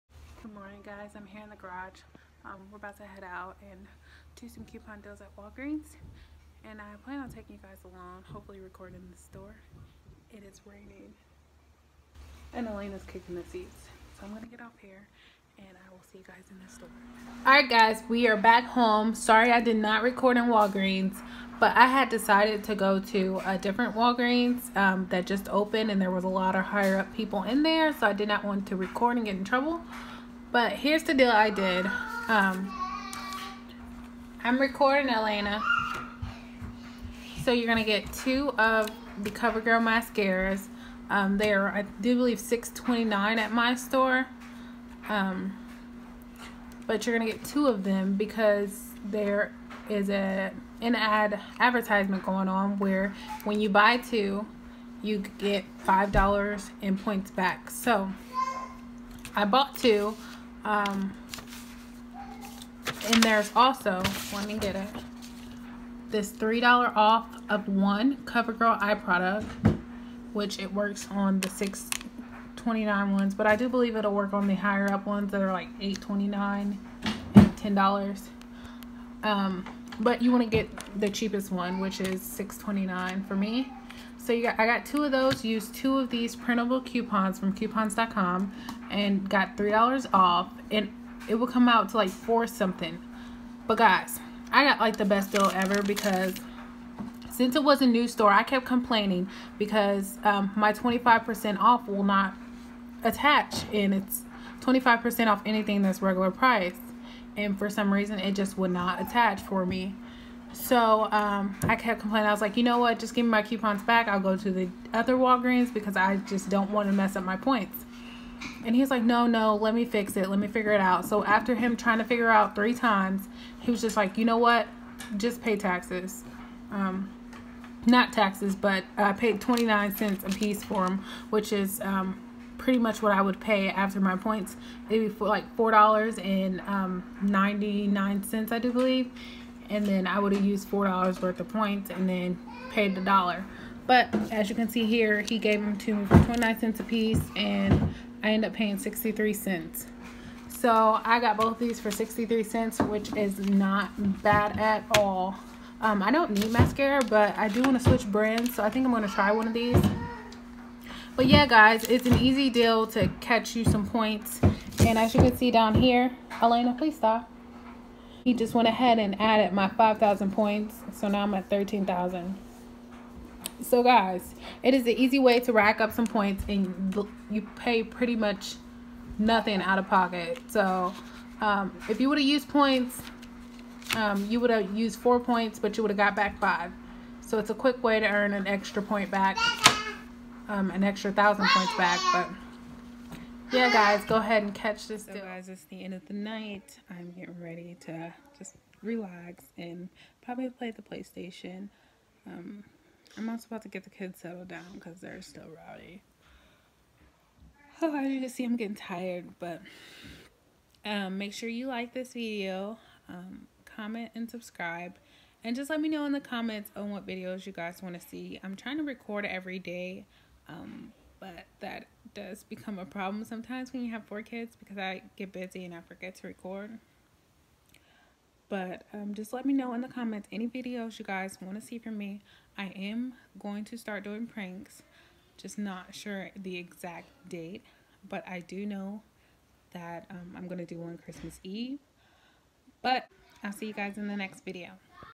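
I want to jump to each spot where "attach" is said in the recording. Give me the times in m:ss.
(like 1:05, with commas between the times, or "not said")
1:43, 1:49.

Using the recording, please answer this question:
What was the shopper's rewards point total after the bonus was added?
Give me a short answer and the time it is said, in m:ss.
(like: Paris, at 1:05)
13,000, at 2:51.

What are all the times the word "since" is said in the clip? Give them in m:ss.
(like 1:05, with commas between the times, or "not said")
1:37.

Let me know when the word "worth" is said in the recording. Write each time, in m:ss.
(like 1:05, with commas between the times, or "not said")
2:21.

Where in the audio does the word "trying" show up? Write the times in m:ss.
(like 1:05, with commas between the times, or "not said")
2:01, 3:38.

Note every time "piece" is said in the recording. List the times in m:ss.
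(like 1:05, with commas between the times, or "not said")
2:10, 2:26.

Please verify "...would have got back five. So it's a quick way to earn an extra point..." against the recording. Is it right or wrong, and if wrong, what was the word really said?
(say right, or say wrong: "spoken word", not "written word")
right.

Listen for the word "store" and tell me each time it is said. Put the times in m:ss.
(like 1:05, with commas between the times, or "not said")
0:09, 0:16, 0:43, 1:38.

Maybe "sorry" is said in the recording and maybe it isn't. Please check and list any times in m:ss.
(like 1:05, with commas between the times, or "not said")
0:19.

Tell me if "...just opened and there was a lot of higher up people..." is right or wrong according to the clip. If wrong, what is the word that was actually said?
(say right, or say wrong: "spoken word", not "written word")
right.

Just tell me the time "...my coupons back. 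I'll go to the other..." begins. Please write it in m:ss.
1:53.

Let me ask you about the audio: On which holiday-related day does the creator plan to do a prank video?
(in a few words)
Christmas Eve.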